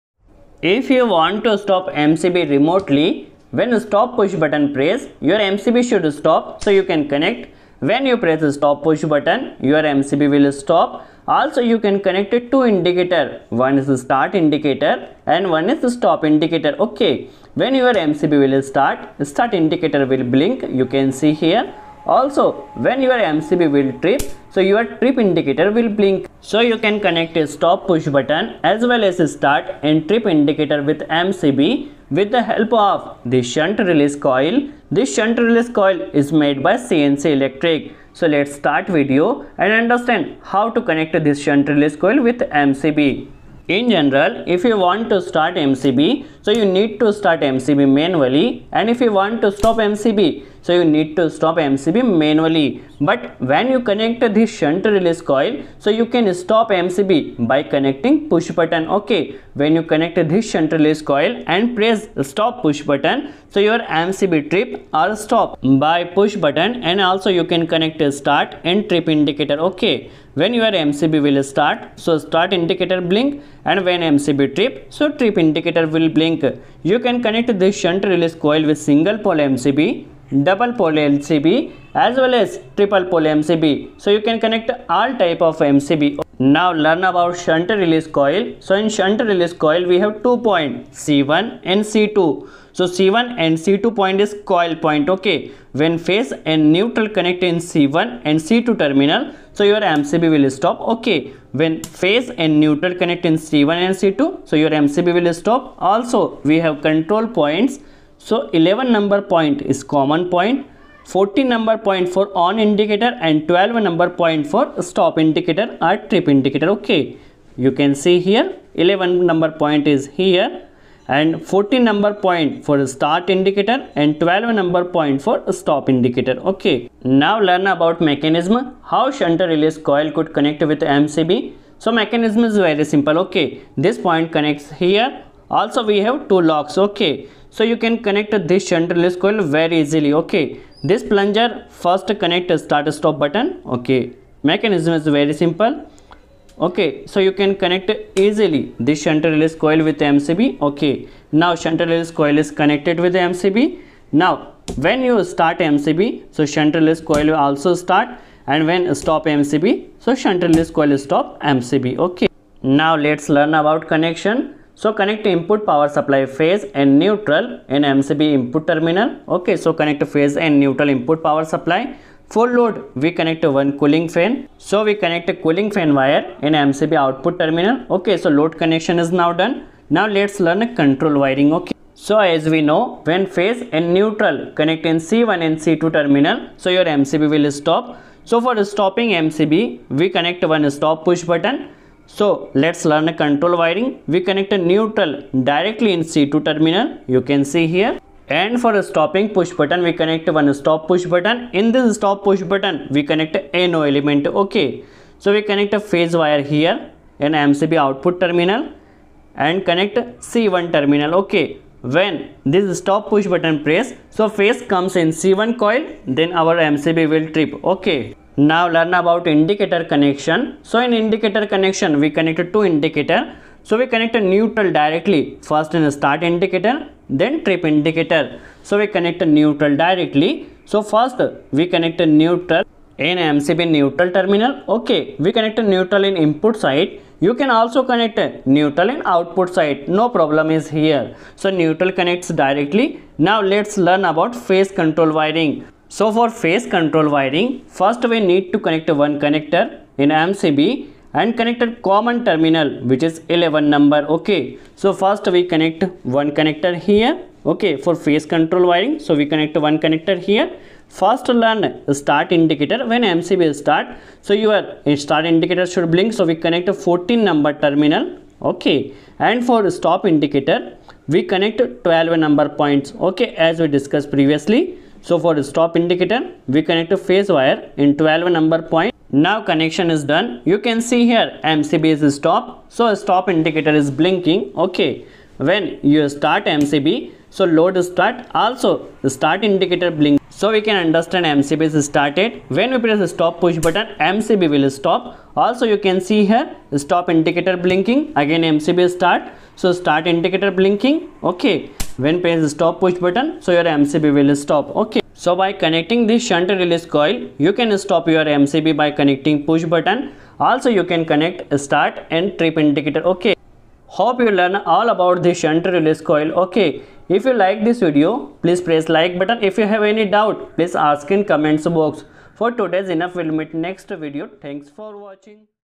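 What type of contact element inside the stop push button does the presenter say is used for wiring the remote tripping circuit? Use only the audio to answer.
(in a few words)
NO element.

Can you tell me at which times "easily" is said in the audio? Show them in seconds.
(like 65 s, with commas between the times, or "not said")
139 s, 148 s.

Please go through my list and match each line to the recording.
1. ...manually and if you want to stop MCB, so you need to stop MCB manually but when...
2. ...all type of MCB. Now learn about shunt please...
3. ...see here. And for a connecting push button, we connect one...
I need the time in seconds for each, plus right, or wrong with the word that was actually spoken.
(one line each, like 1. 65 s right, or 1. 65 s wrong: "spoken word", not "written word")
1. 47 s right
2. 84 s wrong: "release", not "please"
3. 197 s wrong: "stopping", not "connecting".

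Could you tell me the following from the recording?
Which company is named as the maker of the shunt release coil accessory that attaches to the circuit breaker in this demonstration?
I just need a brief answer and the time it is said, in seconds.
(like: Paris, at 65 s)
CNC Electric, at 36 s.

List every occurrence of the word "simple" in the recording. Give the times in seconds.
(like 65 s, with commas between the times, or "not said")
132 s, 145 s.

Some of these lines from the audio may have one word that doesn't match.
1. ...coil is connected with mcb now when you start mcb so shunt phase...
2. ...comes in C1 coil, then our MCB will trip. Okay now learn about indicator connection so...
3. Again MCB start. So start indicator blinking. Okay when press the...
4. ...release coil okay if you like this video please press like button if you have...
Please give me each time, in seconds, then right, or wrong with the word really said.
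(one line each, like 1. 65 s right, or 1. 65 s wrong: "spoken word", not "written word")
1. 152 s wrong: "release", not "phase"
2. 214 s right
3. 298 s right
4. 315 s right.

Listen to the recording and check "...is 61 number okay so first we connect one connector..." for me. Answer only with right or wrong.
wrong.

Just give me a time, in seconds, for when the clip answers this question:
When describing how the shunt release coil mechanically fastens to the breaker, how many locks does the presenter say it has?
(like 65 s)
136 s.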